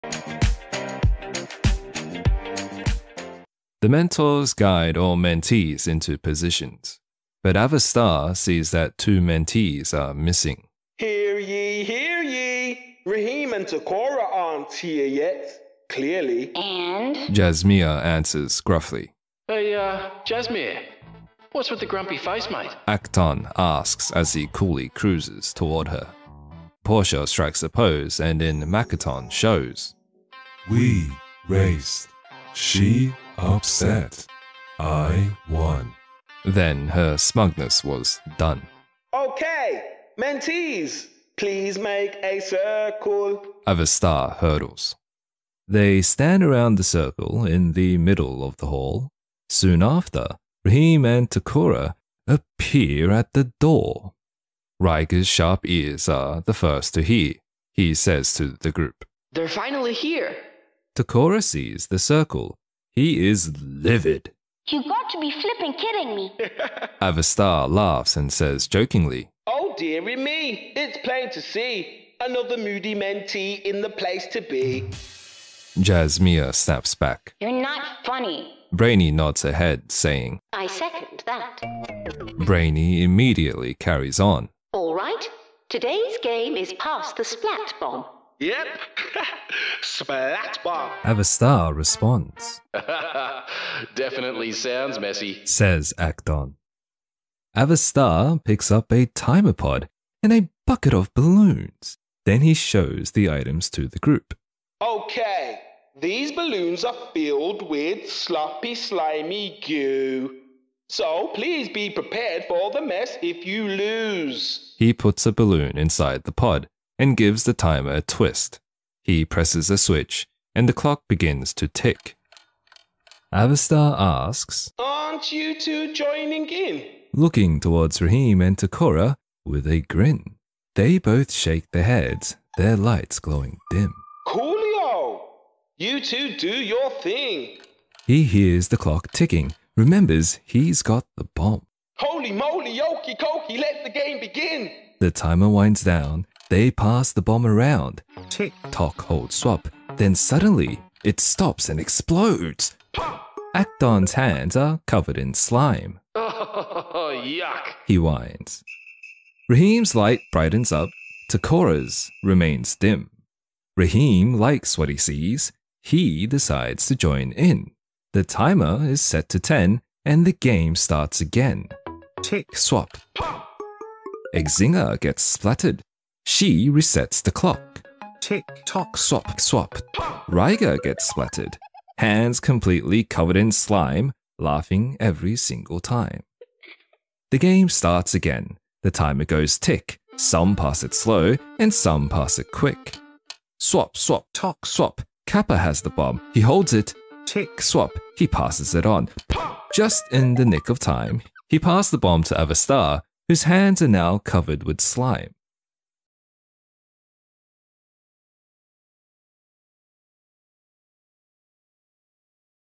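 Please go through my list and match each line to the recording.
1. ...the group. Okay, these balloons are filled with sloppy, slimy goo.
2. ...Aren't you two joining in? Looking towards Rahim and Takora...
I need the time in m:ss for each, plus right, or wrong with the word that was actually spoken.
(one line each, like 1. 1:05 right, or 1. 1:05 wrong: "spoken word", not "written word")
1. 1:43 right
2. 2:04 right.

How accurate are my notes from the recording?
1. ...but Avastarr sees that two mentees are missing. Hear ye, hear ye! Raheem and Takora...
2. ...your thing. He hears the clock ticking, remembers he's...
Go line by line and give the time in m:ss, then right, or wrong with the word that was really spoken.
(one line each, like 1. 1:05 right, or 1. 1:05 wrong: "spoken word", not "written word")
1. 0:07 right
2. 2:16 right.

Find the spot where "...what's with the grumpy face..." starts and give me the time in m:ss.
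0:21.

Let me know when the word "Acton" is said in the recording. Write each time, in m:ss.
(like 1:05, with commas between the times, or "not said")
0:22, 1:35, 2:33.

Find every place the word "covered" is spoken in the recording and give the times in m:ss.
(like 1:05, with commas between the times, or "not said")
2:34, 3:03, 3:24.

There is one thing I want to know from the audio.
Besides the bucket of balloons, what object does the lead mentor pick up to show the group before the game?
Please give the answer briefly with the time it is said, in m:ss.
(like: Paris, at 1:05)
Timer pod, at 1:39.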